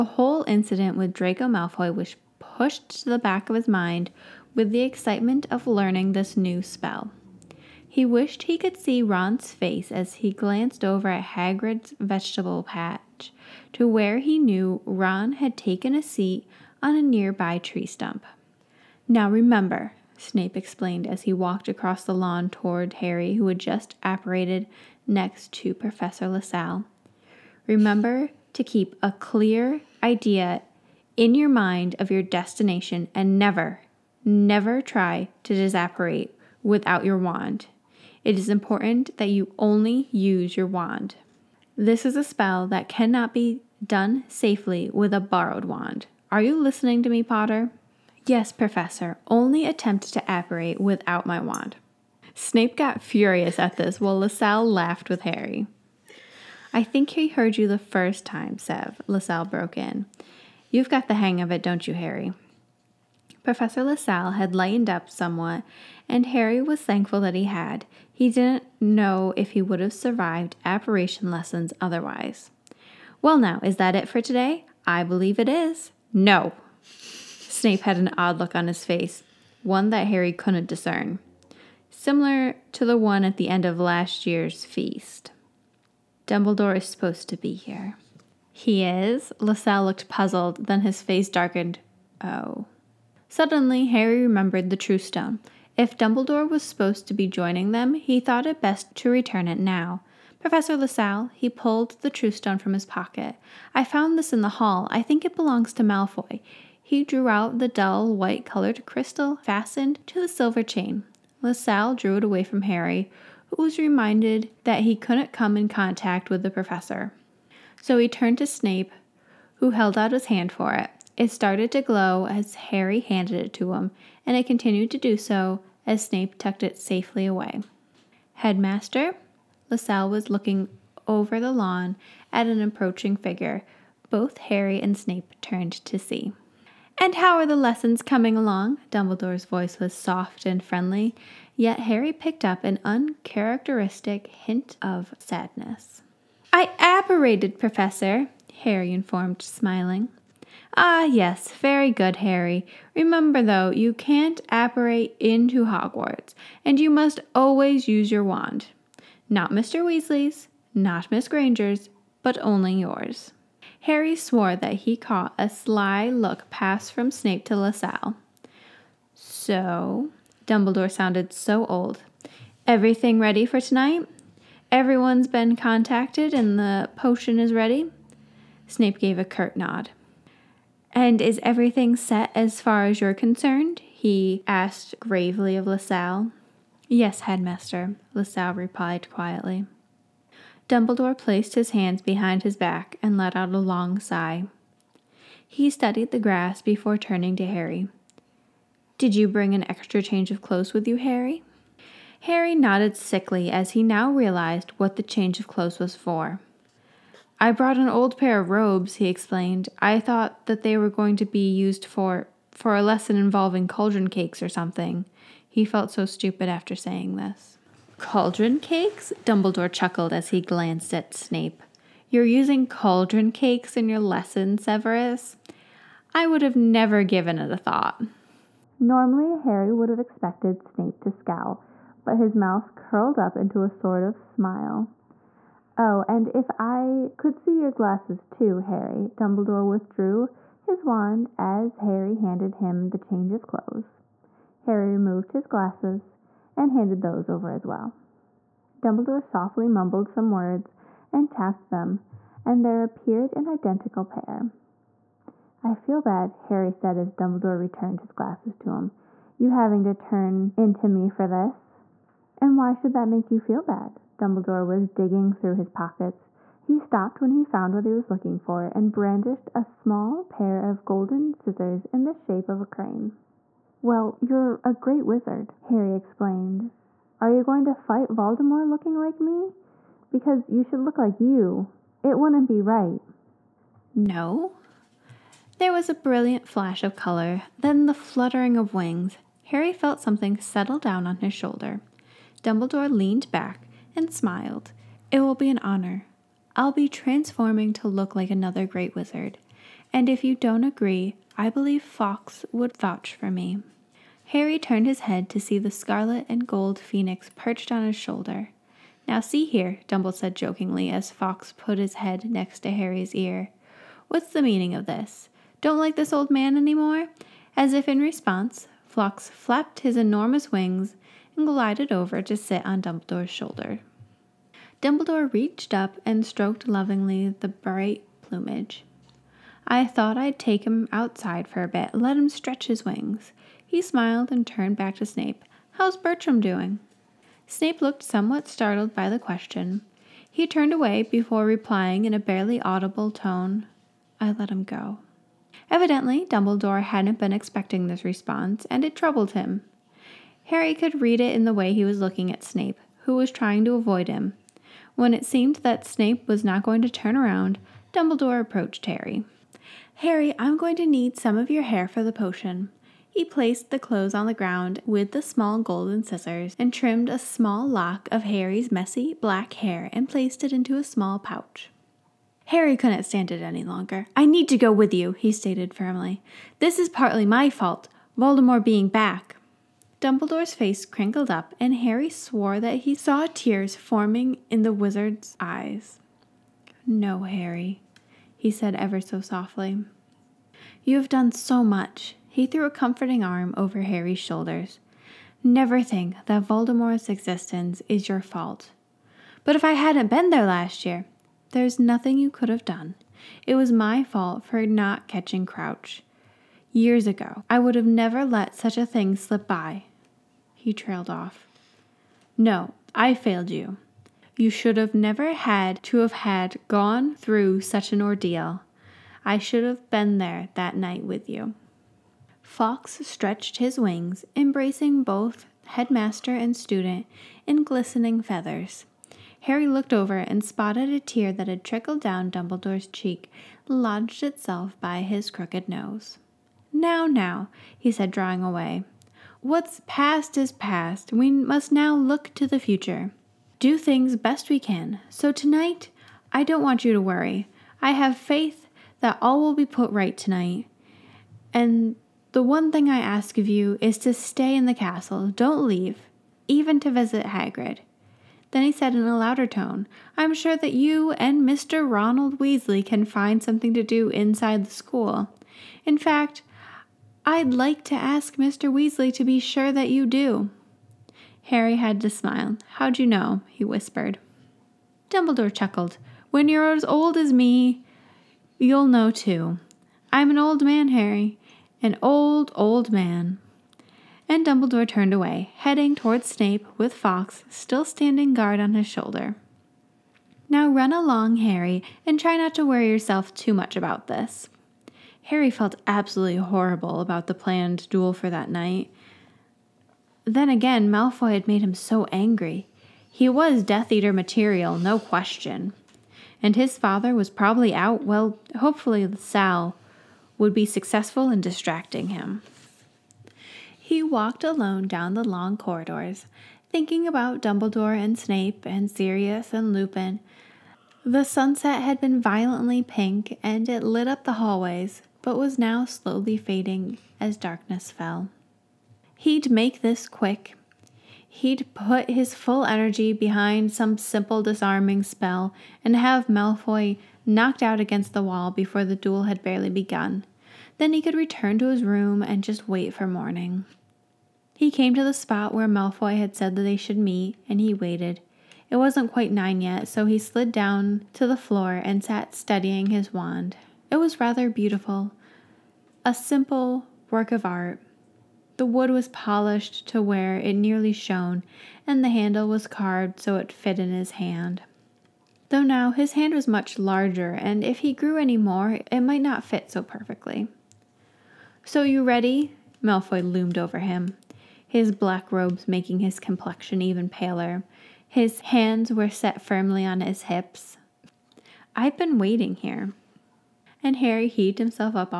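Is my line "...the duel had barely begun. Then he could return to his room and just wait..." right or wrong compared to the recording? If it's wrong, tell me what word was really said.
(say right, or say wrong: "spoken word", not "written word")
right.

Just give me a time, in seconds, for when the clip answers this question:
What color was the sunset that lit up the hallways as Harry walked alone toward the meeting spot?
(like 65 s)
522 s.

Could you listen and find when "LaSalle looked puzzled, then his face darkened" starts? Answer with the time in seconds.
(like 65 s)
89 s.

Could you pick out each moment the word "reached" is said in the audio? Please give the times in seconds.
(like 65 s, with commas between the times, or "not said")
325 s.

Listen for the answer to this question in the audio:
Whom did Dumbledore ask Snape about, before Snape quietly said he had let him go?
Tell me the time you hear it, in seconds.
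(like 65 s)
335 s.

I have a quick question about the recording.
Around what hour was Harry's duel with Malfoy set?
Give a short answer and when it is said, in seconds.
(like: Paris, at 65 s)
9, at 549 s.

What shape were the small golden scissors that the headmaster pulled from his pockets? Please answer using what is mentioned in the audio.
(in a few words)
a crane.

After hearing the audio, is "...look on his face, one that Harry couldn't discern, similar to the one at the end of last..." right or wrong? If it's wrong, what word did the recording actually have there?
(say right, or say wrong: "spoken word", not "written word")
right.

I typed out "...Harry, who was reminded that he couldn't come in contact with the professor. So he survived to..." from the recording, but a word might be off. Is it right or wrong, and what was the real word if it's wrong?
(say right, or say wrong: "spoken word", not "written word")
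wrong: "turned", not "survived".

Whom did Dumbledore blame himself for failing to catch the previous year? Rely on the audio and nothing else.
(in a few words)
Crouch.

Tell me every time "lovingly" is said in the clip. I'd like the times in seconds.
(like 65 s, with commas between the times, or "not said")
326 s.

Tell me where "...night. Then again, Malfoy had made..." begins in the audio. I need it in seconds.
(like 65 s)
498 s.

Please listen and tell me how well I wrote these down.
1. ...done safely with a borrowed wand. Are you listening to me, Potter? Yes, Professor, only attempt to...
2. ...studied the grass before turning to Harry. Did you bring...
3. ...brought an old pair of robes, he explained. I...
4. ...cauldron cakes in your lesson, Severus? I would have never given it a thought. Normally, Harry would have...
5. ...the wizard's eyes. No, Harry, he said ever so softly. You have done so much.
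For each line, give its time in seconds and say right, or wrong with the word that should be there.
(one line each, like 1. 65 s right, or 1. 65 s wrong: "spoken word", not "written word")
1. 43 s right
2. 195 s right
3. 207 s right
4. 222 s right
5. 384 s right.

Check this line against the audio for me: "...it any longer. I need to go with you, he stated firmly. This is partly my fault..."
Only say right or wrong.
right.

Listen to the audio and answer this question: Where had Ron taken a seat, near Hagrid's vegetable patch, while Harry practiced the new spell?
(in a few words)
tree stump.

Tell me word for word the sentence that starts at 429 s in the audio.
Harry looked over and spotted a tear that had trickled down Dumbledore's cheek, lodged itself by his crooked nose.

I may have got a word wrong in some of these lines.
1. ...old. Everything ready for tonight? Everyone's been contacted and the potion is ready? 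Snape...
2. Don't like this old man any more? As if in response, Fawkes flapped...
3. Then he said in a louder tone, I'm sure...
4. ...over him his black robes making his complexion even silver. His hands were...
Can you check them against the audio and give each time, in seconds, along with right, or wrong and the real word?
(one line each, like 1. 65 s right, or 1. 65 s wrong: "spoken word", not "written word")
1. 171 s right
2. 315 s right
3. 458 s right
4. 573 s wrong: "paler", not "silver".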